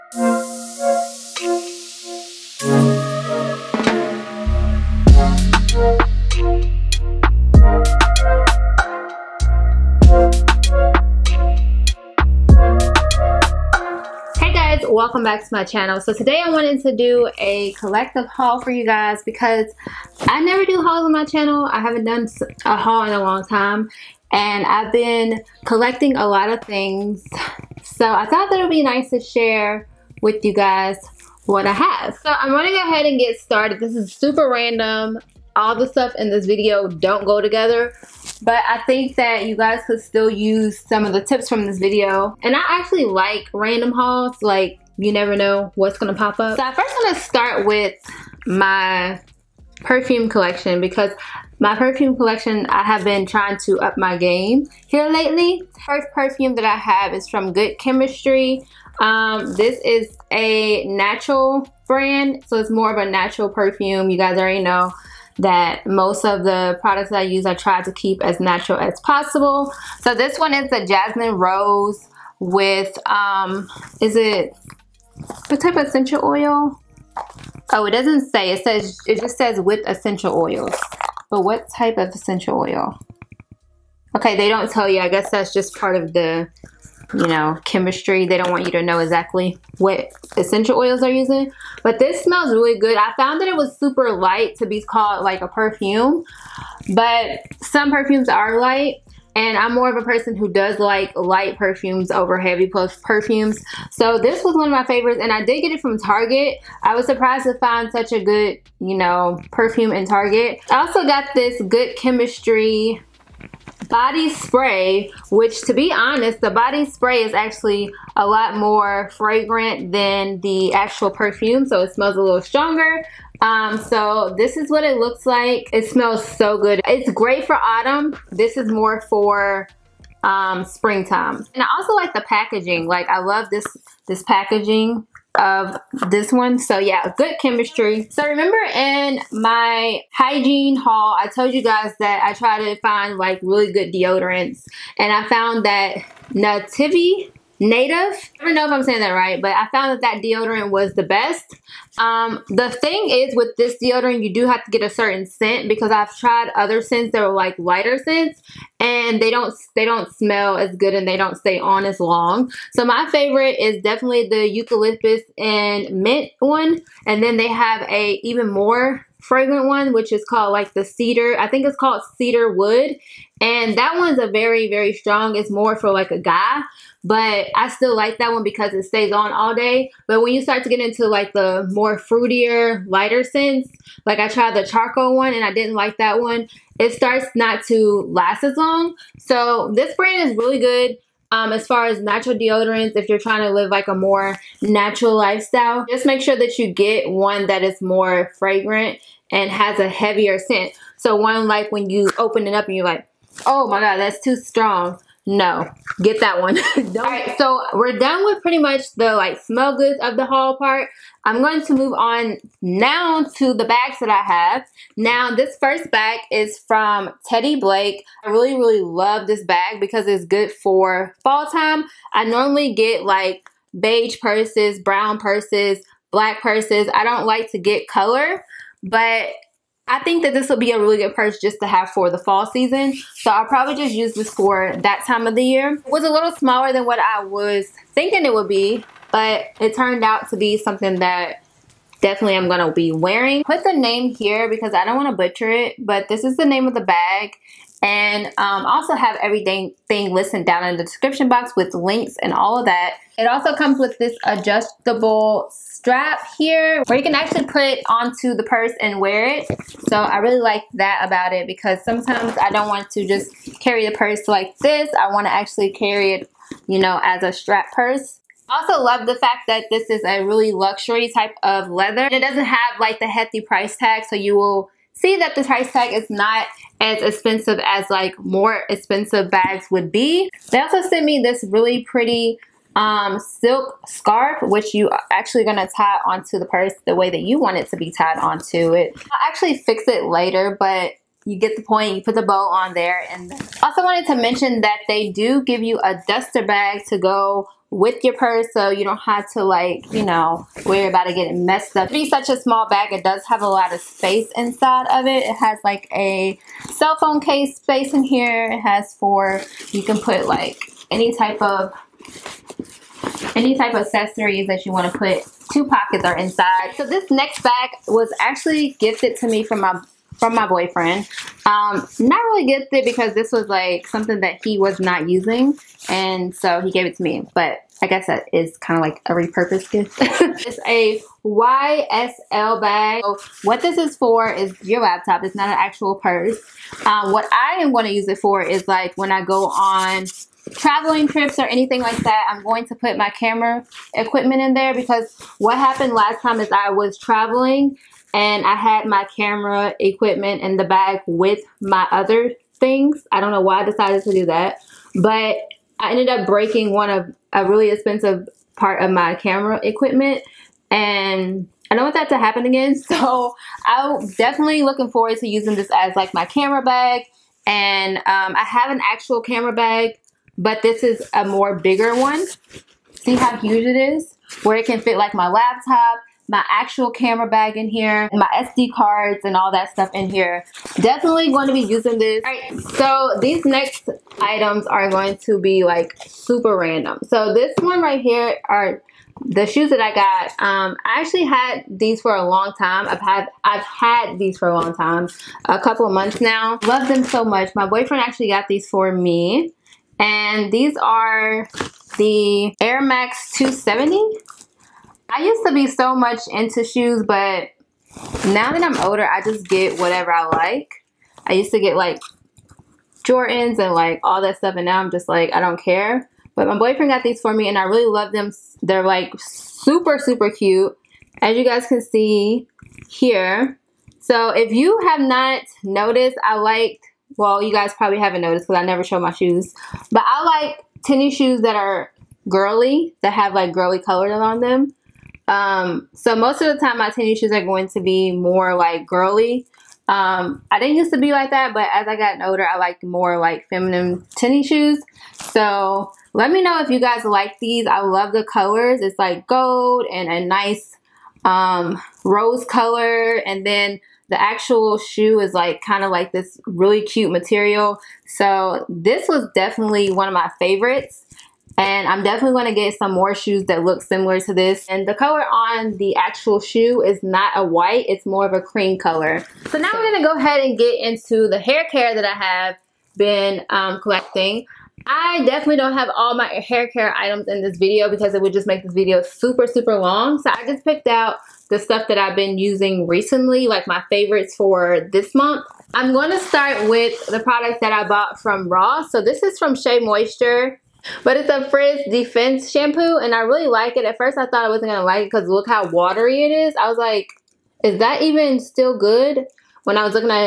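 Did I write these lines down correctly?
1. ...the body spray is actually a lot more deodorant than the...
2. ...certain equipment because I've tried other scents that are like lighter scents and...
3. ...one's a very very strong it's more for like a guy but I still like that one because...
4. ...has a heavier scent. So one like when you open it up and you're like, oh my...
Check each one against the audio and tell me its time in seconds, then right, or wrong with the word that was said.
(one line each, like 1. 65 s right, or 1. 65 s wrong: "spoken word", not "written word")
1. 116 s wrong: "fragrant", not "deodorant"
2. 154 s wrong: "scent", not "equipment"
3. 173 s right
4. 199 s right.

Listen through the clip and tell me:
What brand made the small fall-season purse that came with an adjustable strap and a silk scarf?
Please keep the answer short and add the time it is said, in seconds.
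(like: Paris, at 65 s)
Teddy Blake, at 217 s.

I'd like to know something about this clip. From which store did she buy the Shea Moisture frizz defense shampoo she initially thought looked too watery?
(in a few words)
Ross.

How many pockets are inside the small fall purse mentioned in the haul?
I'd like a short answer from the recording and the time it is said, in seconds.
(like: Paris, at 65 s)
2, at 315 s.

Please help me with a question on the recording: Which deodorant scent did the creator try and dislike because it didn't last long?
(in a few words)
charcoal.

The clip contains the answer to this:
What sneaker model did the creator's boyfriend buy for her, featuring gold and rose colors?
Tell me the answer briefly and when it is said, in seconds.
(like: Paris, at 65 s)
Air Max 270, at 402 s.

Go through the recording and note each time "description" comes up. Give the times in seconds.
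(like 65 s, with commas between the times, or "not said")
250 s.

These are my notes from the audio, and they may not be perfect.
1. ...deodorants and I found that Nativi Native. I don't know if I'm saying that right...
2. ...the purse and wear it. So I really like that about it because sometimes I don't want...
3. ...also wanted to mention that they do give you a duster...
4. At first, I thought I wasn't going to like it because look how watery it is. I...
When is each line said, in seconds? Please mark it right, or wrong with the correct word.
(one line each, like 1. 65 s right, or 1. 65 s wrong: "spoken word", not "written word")
1. 143 s right
2. 258 s right
3. 293 s right
4. 493 s right.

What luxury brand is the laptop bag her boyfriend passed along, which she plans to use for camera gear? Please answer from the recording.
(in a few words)
YSL.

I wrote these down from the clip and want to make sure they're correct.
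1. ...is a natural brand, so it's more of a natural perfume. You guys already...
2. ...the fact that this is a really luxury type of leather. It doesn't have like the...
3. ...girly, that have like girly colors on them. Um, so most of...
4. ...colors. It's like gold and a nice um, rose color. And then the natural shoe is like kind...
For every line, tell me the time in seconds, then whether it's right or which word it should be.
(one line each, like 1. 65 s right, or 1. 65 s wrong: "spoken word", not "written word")
1. 59 s right
2. 269 s right
3. 432 s right
4. 448 s wrong: "actual", not "natural".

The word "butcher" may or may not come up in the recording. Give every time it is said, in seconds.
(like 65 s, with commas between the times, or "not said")
245 s.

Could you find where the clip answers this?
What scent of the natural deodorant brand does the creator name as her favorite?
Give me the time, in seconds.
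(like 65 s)
164 s.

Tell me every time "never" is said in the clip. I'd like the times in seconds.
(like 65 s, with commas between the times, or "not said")
20 s, 45 s, 428 s.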